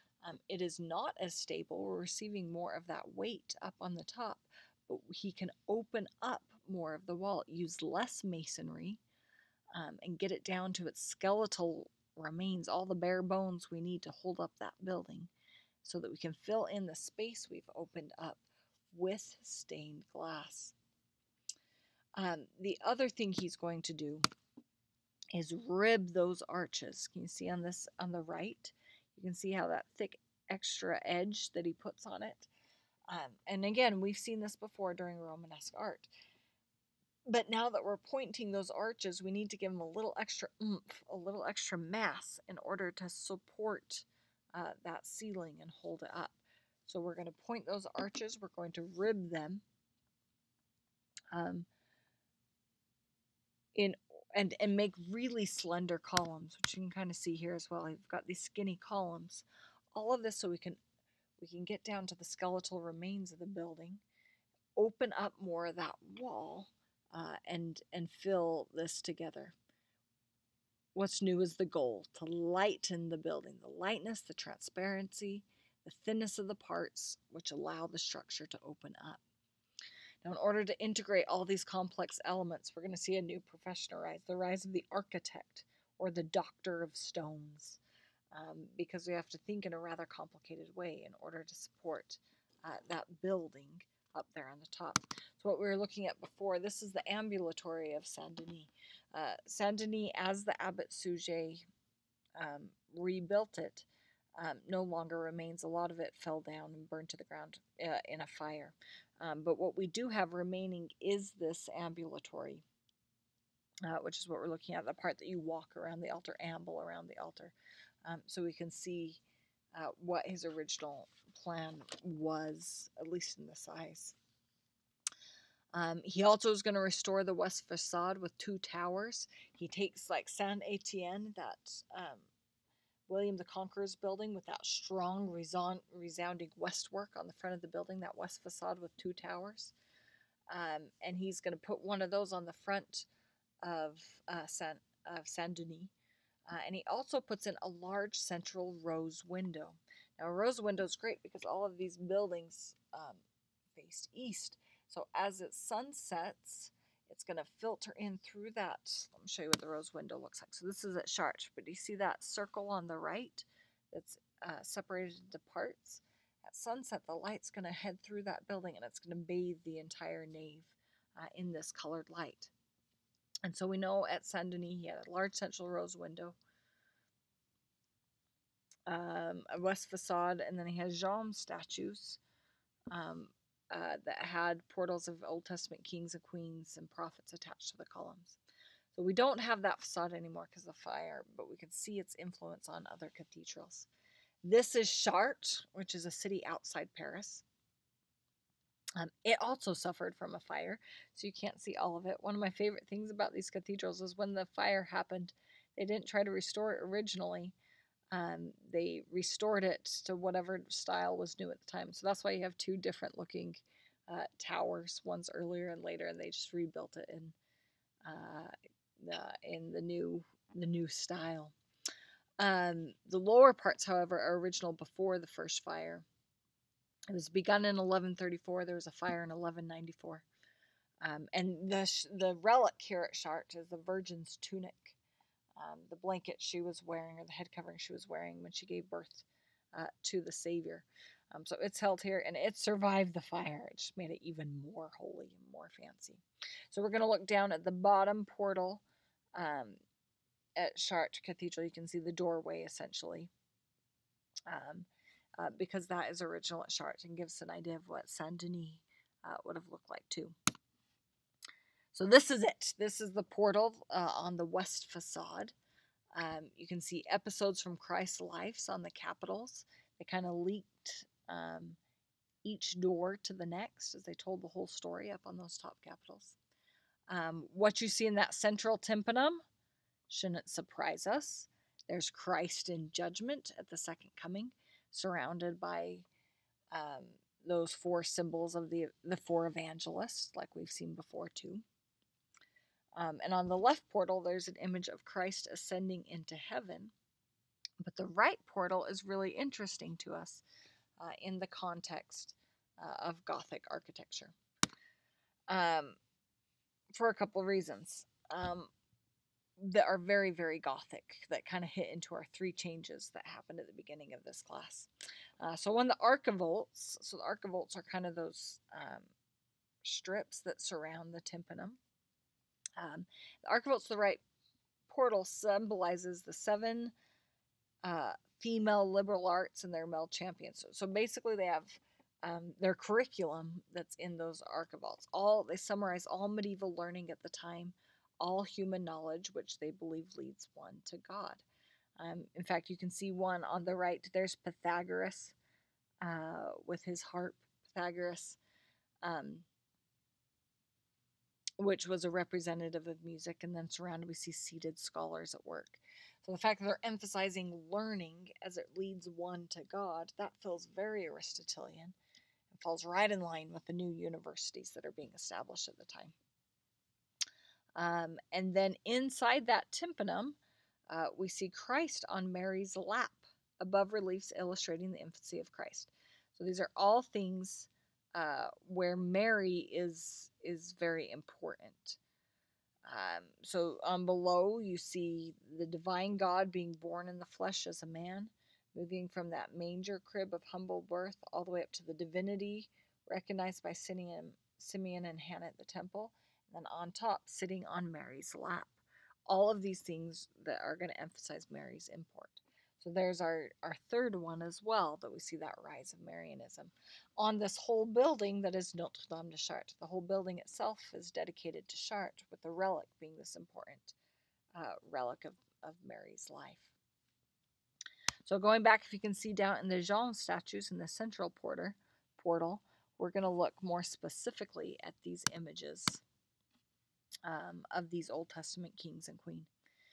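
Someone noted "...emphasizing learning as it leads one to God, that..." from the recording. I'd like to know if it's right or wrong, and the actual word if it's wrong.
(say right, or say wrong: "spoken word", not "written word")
right.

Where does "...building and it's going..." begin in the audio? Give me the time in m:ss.
2:48.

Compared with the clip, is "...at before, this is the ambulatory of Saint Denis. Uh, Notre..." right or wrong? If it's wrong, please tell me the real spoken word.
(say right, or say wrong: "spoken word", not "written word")
wrong: "Saint", not "Notre".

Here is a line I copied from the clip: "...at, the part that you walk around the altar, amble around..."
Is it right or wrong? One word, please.
right.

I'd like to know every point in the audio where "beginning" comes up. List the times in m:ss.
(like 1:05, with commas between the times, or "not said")
5:13.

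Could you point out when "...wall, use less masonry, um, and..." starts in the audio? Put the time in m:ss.
0:07.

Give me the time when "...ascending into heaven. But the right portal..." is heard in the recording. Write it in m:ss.
4:55.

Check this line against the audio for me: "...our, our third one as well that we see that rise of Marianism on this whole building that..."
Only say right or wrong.
right.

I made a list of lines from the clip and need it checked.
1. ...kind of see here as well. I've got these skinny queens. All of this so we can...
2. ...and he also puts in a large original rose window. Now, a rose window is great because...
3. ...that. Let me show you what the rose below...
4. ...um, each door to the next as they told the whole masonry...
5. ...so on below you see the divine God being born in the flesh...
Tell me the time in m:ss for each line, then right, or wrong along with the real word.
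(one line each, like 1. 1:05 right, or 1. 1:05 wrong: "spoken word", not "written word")
1. 0:56 wrong: "columns", not "queens"
2. 2:26 wrong: "central", not "original"
3. 2:38 wrong: "window", not "below"
4. 4:31 wrong: "story", not "masonry"
5. 6:23 right.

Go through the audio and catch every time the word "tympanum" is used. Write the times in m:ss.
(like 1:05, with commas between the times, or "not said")
4:38, 5:21, 6:09.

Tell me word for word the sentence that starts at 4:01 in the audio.
Um, so it's held here and it survived the fire.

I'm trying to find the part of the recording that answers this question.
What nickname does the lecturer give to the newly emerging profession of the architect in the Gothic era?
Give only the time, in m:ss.
1:26.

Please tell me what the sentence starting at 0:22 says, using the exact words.
Um, the other thing he's going to do is rib those arches.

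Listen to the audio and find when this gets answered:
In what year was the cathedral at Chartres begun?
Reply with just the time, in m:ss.
3:47.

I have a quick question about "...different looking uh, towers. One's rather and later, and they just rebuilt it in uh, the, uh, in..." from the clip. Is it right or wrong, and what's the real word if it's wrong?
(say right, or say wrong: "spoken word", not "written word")
wrong: "earlier", not "rather".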